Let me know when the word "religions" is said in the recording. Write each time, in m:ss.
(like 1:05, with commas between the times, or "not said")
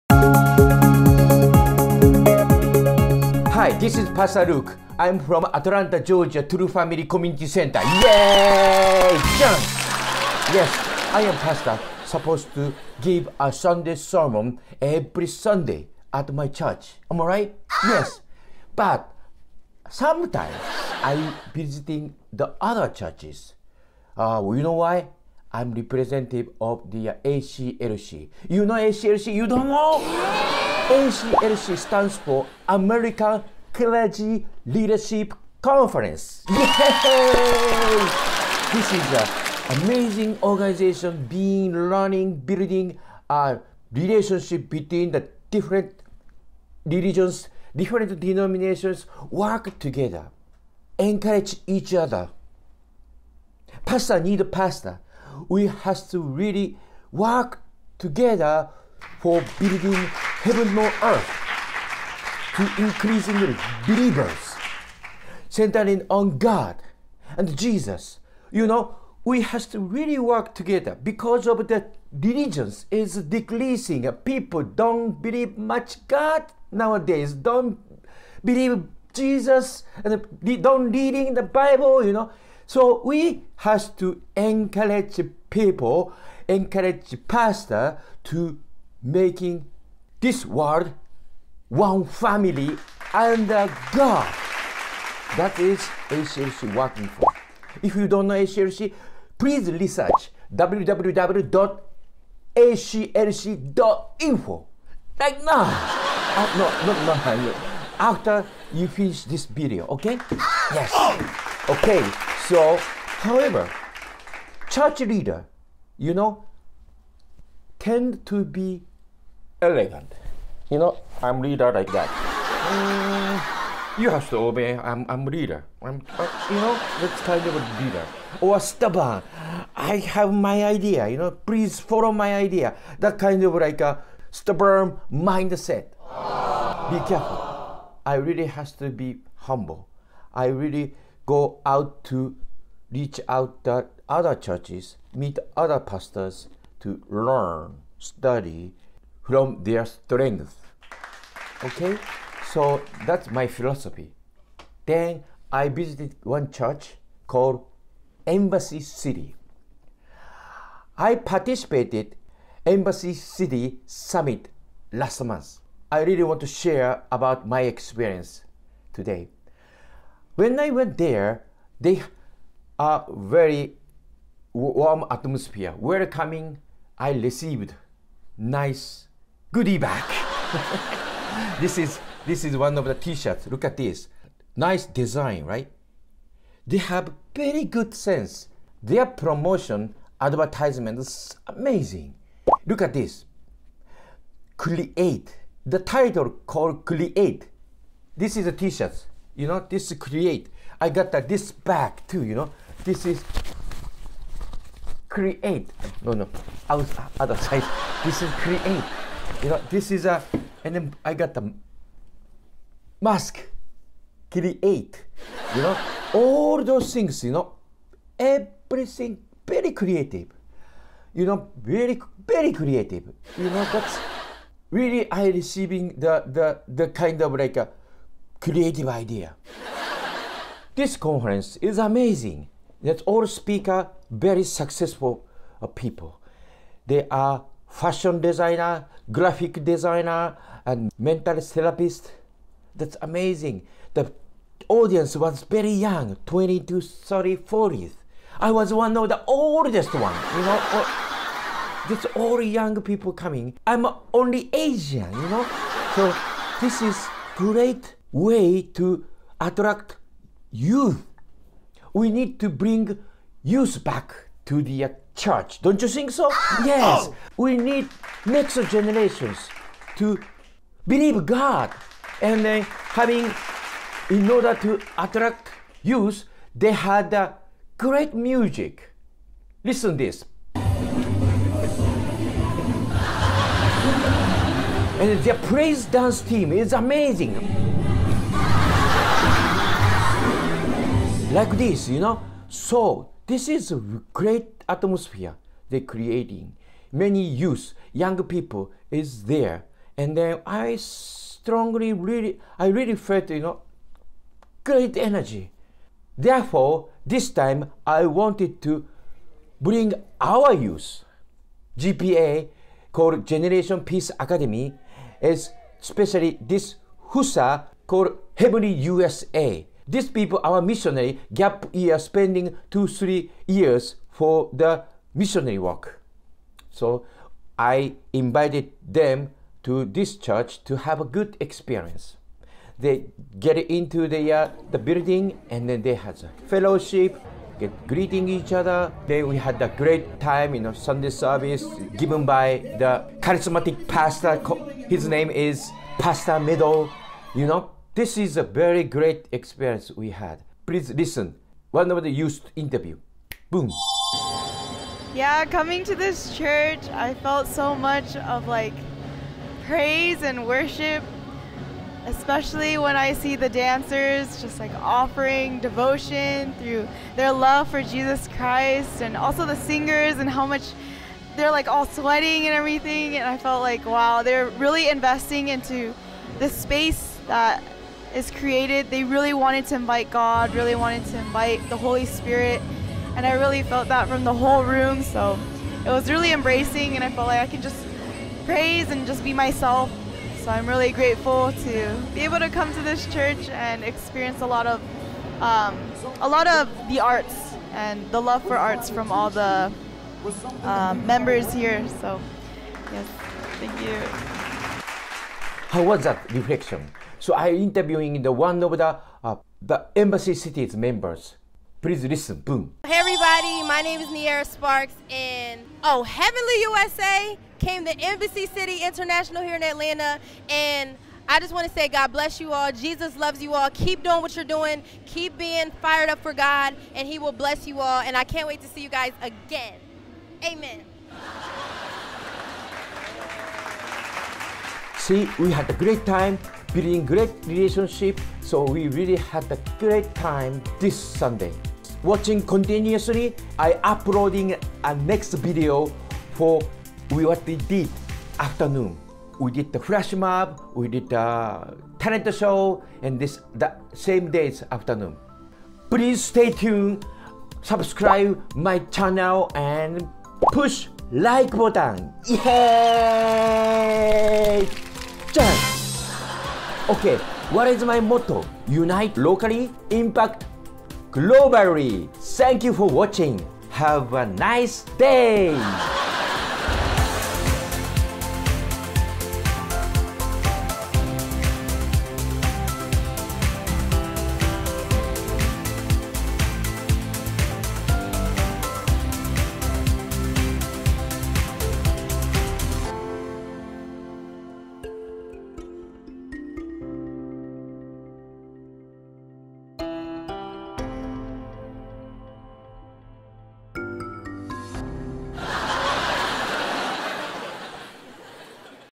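0:46, 1:12.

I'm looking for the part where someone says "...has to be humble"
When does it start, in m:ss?
2:18.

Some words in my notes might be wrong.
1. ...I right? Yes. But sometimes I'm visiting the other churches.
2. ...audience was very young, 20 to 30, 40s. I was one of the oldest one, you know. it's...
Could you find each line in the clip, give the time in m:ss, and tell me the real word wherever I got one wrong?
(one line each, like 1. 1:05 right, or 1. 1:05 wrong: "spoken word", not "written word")
1. 0:17 right
2. 4:04 right.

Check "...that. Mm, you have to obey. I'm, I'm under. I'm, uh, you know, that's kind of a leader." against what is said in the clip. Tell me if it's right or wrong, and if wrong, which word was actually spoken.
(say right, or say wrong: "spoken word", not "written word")
wrong: "leader", not "under".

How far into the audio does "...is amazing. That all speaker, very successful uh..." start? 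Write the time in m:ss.
3:51.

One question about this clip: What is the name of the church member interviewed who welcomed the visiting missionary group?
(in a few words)
Niera Sparks.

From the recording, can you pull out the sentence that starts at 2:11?
You know, please follow my idea.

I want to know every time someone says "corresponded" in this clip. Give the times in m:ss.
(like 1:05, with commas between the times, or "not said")
not said.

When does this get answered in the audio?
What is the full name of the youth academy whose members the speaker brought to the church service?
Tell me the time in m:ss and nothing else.
5:13.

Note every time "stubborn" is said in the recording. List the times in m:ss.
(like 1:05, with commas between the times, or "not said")
2:08, 2:14.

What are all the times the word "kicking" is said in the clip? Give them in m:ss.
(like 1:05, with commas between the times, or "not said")
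not said.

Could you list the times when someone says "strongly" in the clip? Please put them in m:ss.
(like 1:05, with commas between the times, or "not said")
5:00.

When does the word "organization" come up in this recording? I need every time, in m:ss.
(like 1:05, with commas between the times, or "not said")
0:40.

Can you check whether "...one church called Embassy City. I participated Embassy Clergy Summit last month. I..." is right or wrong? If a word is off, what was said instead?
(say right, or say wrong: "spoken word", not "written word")
wrong: "City", not "Clergy".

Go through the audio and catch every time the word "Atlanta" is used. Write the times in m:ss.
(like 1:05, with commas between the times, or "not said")
0:05, 6:59.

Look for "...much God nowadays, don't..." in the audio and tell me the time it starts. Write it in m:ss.
1:15.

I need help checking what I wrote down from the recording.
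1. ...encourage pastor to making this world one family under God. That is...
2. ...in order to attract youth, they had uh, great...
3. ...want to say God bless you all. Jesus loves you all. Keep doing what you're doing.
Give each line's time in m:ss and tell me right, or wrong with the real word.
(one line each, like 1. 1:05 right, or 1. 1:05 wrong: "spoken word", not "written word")
1. 1:26 right
2. 4:34 right
3. 7:01 right.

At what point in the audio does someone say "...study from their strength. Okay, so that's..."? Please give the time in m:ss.
2:27.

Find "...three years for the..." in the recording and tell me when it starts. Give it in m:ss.
5:22.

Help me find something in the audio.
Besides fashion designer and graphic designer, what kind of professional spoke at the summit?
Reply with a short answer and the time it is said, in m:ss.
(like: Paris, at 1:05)
Mental therapist, at 4:00.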